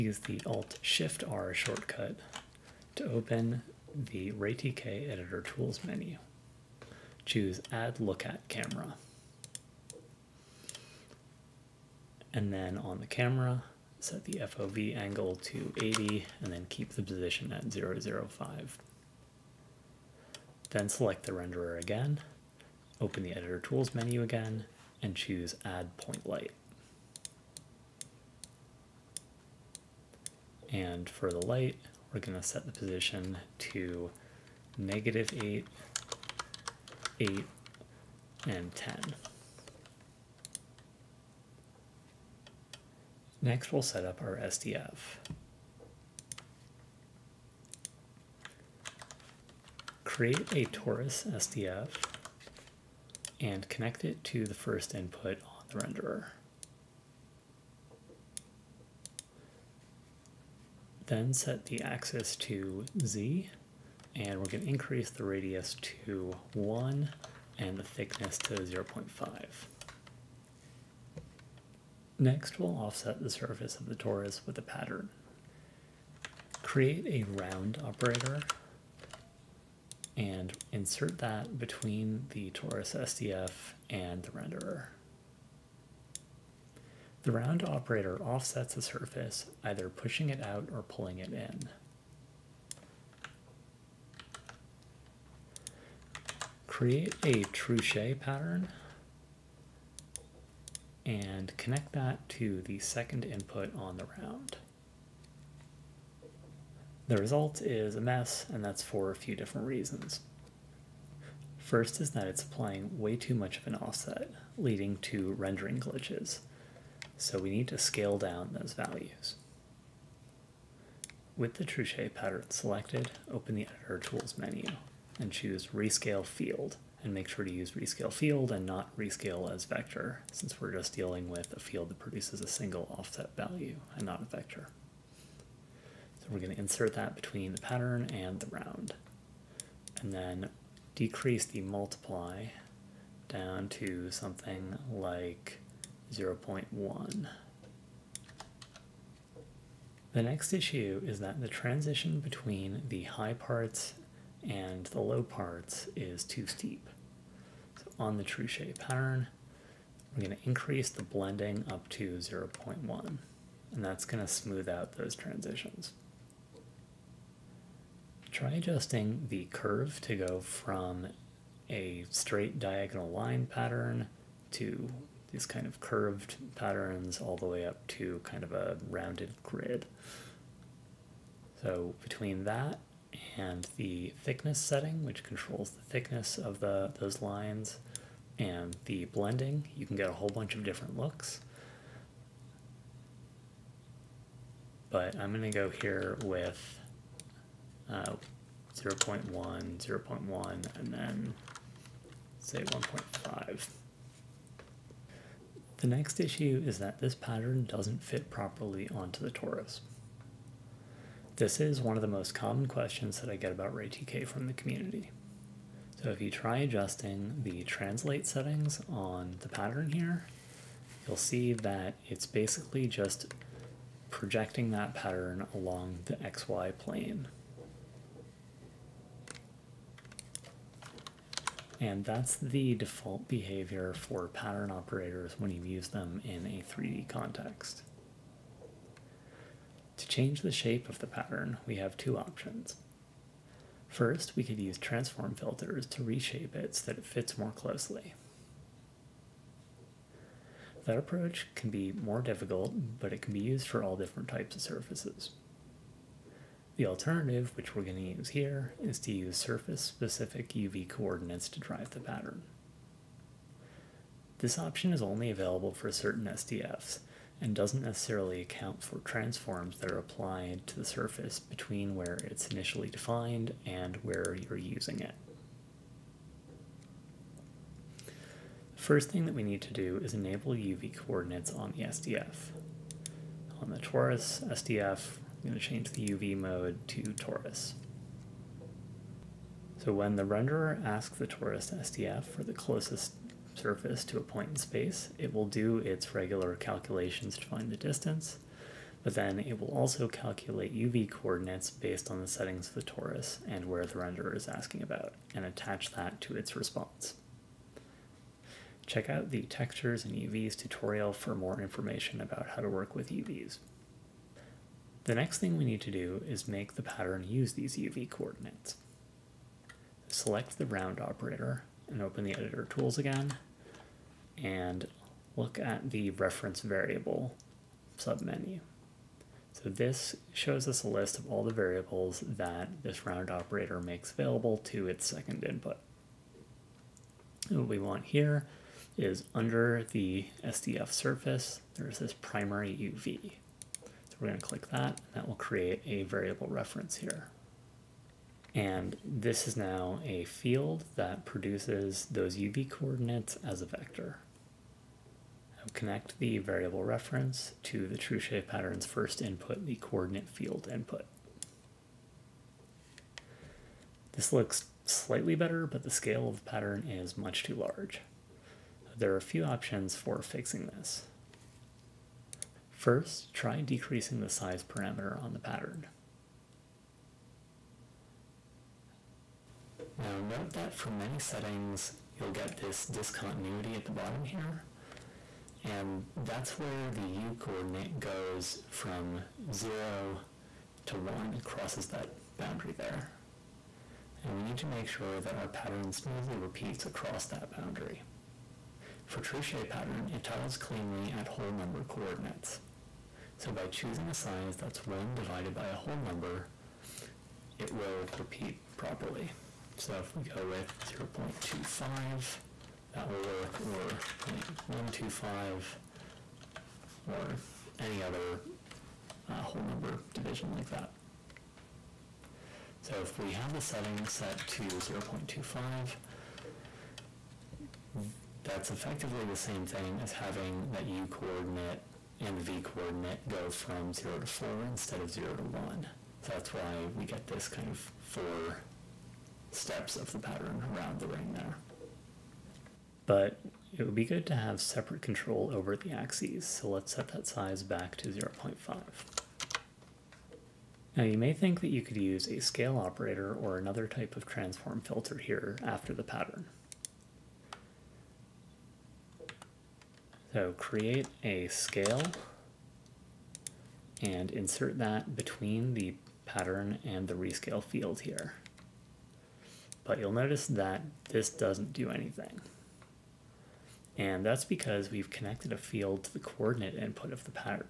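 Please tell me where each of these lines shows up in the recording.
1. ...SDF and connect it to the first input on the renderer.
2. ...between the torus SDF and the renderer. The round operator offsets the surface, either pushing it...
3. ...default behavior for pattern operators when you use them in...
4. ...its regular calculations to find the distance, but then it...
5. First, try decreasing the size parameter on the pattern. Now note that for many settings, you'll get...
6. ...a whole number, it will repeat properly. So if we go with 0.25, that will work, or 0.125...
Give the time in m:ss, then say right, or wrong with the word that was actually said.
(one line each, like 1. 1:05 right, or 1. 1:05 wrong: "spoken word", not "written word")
1. 0:51 right
2. 1:21 right
3. 3:52 right
4. 4:55 right
5. 6:12 right
6. 6:45 right.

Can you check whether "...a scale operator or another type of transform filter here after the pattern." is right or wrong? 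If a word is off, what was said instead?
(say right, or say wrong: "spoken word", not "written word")
right.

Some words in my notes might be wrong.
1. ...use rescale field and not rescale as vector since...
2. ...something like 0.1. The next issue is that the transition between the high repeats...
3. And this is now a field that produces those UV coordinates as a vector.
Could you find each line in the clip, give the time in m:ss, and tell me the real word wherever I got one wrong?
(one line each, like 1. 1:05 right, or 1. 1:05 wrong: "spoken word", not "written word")
1. 2:07 right
2. 2:24 wrong: "parts", not "repeats"
3. 5:48 right.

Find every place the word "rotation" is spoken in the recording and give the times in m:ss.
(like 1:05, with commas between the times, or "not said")
not said.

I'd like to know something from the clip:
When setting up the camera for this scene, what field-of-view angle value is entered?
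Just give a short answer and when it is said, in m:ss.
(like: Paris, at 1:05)
80, at 0:15.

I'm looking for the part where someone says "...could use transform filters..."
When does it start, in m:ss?
4:04.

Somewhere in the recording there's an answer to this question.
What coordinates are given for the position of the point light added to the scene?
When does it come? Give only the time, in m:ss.
0:34.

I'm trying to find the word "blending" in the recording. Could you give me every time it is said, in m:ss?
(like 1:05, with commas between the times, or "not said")
2:41, 3:09.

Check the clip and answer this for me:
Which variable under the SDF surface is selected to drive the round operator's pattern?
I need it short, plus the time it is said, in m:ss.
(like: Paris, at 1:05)
primary UV, at 5:42.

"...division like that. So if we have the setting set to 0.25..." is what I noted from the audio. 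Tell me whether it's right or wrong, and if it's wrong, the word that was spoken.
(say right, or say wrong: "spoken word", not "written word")
right.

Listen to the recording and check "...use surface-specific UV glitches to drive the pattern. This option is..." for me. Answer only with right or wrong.
wrong.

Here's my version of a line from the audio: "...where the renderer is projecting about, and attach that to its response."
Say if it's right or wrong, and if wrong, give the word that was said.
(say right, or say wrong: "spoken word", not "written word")
wrong: "asking", not "projecting".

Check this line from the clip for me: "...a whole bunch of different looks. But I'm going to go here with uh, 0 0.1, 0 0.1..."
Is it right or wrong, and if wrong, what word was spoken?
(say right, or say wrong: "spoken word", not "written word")
right.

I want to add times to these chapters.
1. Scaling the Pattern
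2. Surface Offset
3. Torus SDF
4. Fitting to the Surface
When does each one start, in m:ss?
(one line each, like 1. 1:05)
1. 6:02
2. 1:11
3. 0:41
4. 3:24.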